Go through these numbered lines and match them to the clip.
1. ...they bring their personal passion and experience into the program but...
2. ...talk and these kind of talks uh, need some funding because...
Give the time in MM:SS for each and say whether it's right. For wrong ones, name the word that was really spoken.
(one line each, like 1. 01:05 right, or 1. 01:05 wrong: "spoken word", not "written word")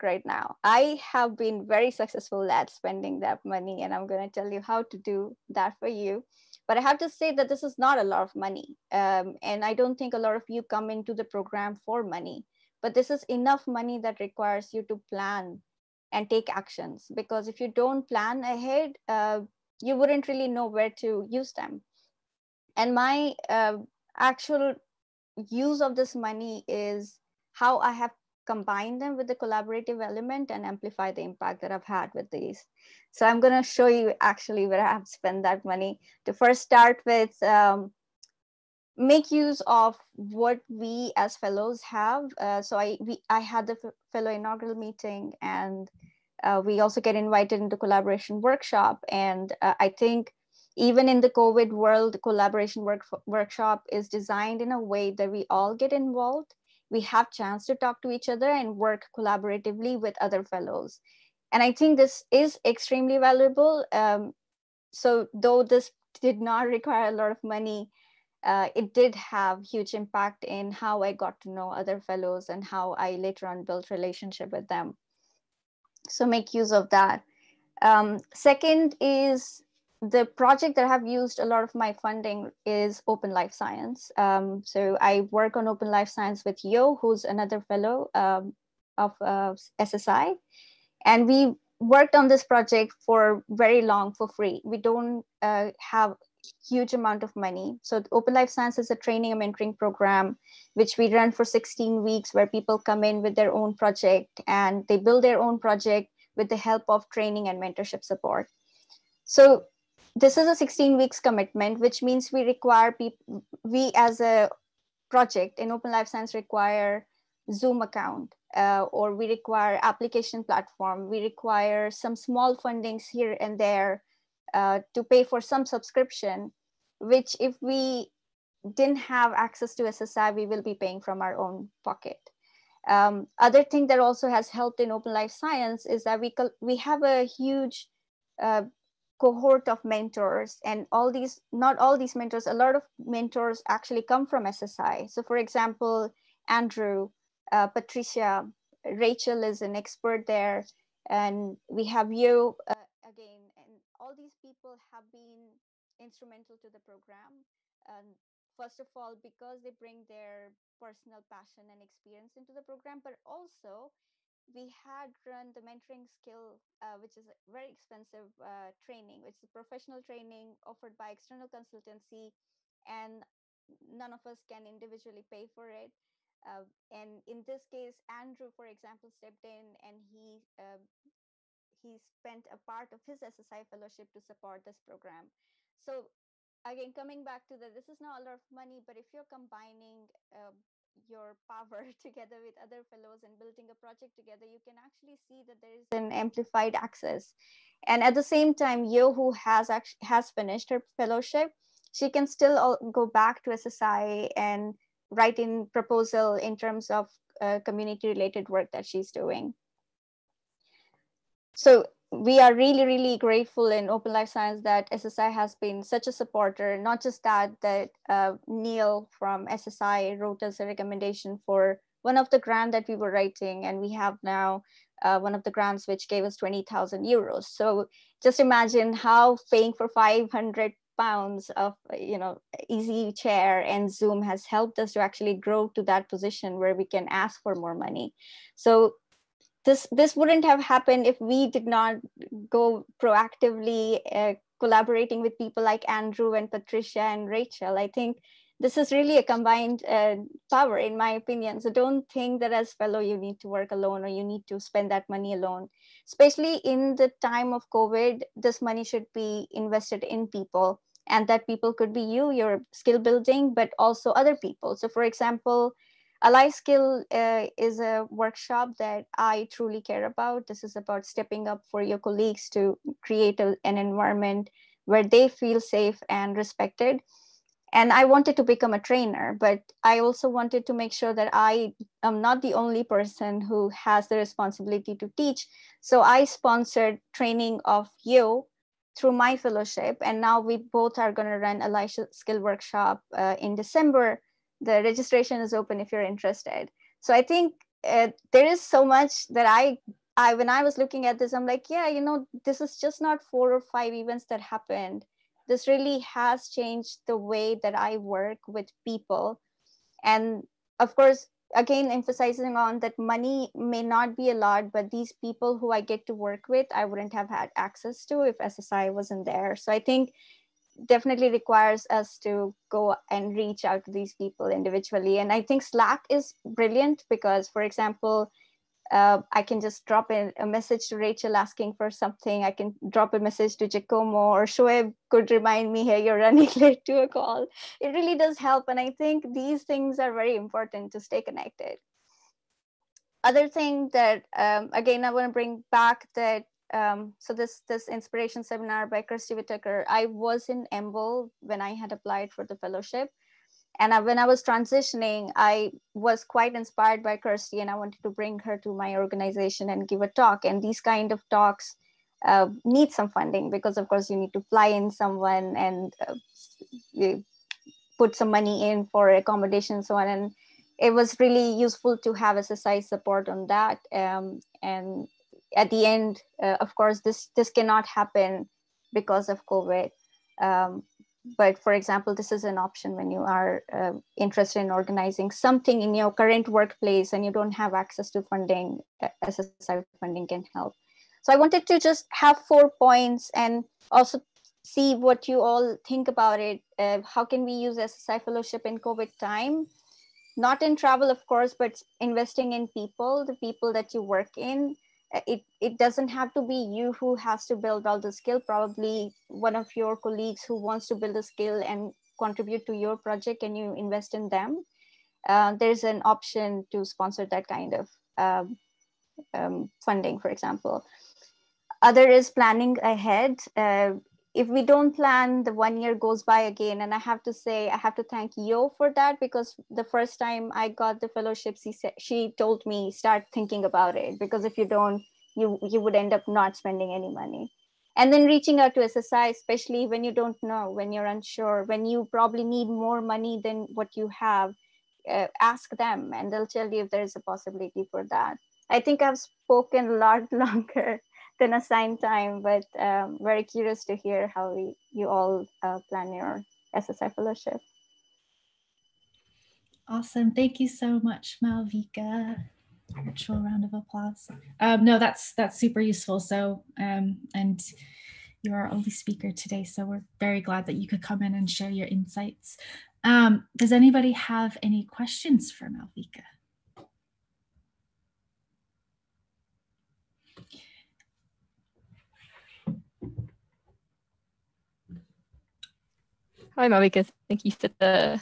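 1. 02:39 right
2. 06:00 right.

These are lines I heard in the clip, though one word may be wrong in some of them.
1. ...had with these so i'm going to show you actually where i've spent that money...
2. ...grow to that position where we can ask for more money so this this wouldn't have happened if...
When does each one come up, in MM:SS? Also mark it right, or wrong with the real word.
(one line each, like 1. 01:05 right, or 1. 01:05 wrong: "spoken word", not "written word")
1. 00:31 right
2. 03:55 right.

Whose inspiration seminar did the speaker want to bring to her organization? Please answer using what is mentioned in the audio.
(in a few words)
Kirstie Whitaker.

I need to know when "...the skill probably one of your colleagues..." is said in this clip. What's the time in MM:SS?
06:47.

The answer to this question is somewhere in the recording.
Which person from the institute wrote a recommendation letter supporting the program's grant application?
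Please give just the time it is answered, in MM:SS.
03:38.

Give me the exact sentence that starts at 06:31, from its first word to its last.
So I wanted to just have four points and also see what you all think about it.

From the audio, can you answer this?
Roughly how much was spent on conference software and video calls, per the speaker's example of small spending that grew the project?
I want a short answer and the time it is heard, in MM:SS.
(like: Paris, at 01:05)
500 pounds, at 03:49.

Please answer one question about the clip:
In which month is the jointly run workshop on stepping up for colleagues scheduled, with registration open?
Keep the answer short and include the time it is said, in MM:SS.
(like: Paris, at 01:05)
December, at 04:53.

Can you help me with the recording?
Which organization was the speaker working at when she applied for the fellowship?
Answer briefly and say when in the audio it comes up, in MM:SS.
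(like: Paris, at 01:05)
EMBL, at 05:50.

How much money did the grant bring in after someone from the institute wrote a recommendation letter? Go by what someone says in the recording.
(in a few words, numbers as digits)
20,000 euros.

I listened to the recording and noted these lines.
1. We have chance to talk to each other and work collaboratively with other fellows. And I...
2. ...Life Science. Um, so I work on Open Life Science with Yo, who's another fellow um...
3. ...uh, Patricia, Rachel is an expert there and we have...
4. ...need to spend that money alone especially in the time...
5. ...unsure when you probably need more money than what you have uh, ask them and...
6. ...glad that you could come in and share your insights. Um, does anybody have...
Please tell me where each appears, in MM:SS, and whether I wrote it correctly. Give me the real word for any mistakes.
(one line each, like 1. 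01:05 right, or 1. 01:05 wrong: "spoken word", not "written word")
1. 00:56 right
2. 01:23 right
3. 02:27 right
4. 04:14 right
5. 07:21 right
6. 07:50 right.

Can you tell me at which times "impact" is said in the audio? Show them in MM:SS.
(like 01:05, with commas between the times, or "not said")
00:31, 01:09.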